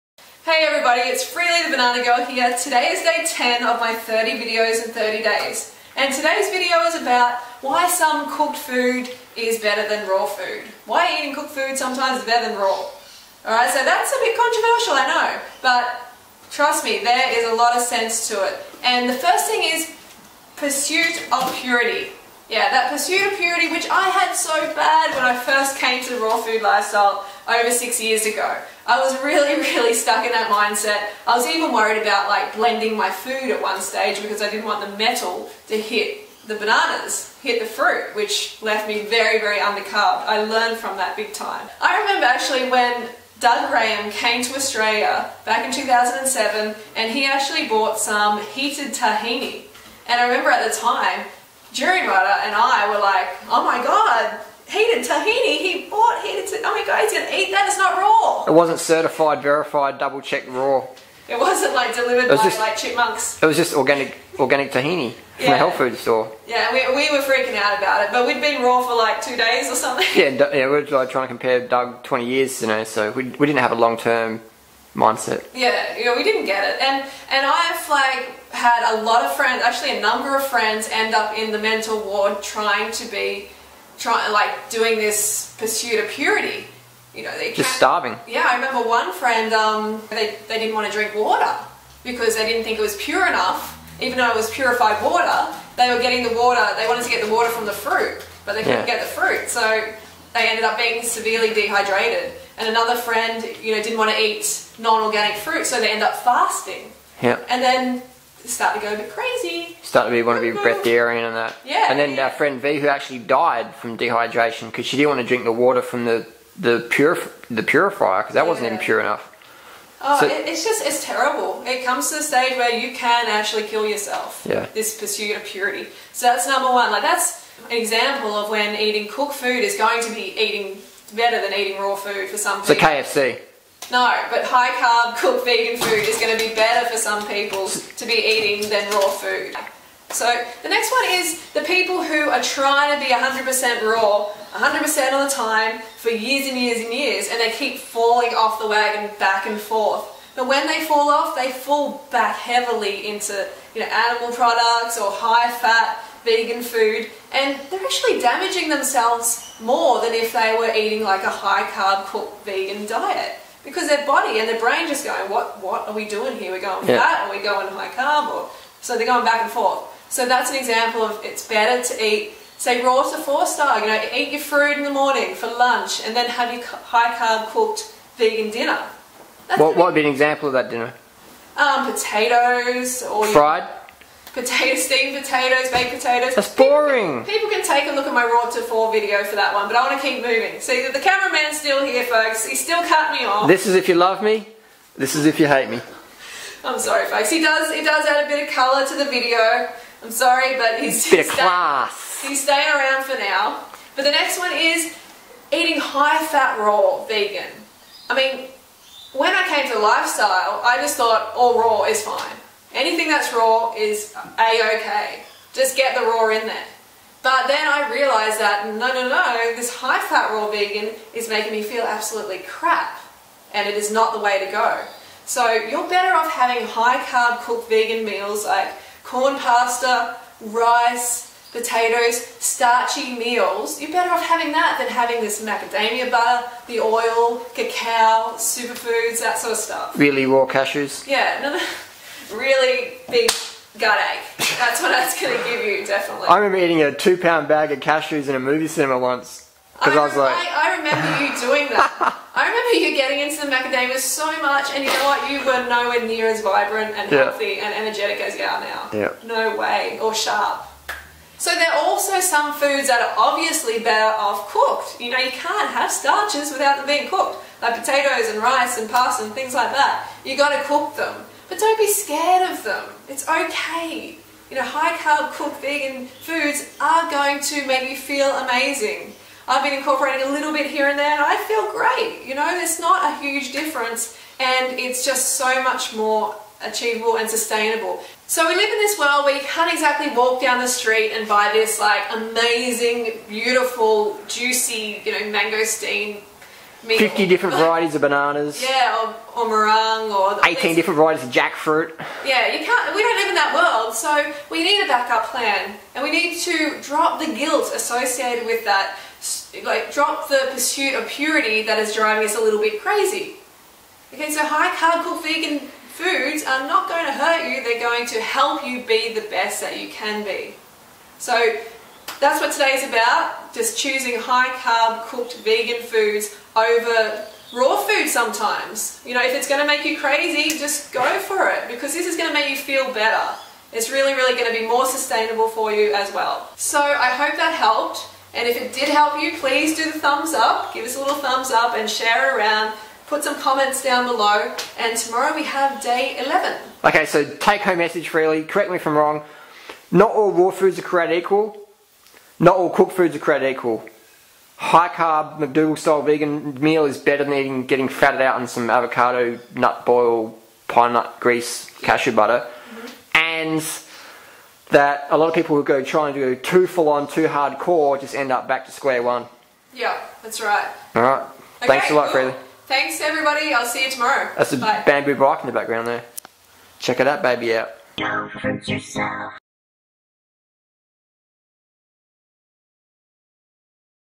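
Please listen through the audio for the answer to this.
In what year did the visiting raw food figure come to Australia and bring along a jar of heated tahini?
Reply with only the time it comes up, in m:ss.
0:45.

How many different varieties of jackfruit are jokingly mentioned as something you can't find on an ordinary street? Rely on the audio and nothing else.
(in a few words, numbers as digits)
18.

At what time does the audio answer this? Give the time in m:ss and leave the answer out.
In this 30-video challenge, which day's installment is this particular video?
0:03.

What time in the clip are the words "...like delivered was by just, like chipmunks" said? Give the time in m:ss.
1:01.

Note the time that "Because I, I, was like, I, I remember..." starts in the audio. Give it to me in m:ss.
4:09.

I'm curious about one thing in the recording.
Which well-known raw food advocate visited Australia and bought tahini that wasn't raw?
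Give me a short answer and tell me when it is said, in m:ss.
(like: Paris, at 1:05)
Doug Graham, at 0:43.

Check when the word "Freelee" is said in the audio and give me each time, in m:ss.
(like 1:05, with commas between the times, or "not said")
0:01, 6:12.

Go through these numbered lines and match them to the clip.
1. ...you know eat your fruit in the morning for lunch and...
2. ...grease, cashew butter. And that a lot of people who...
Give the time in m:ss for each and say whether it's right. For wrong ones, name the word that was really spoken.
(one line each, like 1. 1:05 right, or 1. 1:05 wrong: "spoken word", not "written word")
1. 2:53 right
2. 6:01 right.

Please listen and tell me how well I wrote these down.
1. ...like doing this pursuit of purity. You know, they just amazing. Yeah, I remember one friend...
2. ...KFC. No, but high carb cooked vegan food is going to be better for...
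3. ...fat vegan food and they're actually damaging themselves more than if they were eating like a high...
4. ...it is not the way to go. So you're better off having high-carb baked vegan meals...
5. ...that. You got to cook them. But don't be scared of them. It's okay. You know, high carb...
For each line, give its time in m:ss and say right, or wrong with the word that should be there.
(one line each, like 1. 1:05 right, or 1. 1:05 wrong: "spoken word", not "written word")
1. 1:24 wrong: "starving", not "amazing"
2. 2:12 right
3. 2:35 right
4. 3:43 wrong: "cooked", not "baked"
5. 4:29 right.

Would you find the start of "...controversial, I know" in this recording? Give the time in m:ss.
0:14.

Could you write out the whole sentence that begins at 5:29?
You know, if it's going to make you crazy, just go for it because this is going to make you feel better.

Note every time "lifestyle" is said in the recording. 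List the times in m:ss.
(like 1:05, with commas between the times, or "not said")
0:26, 3:29.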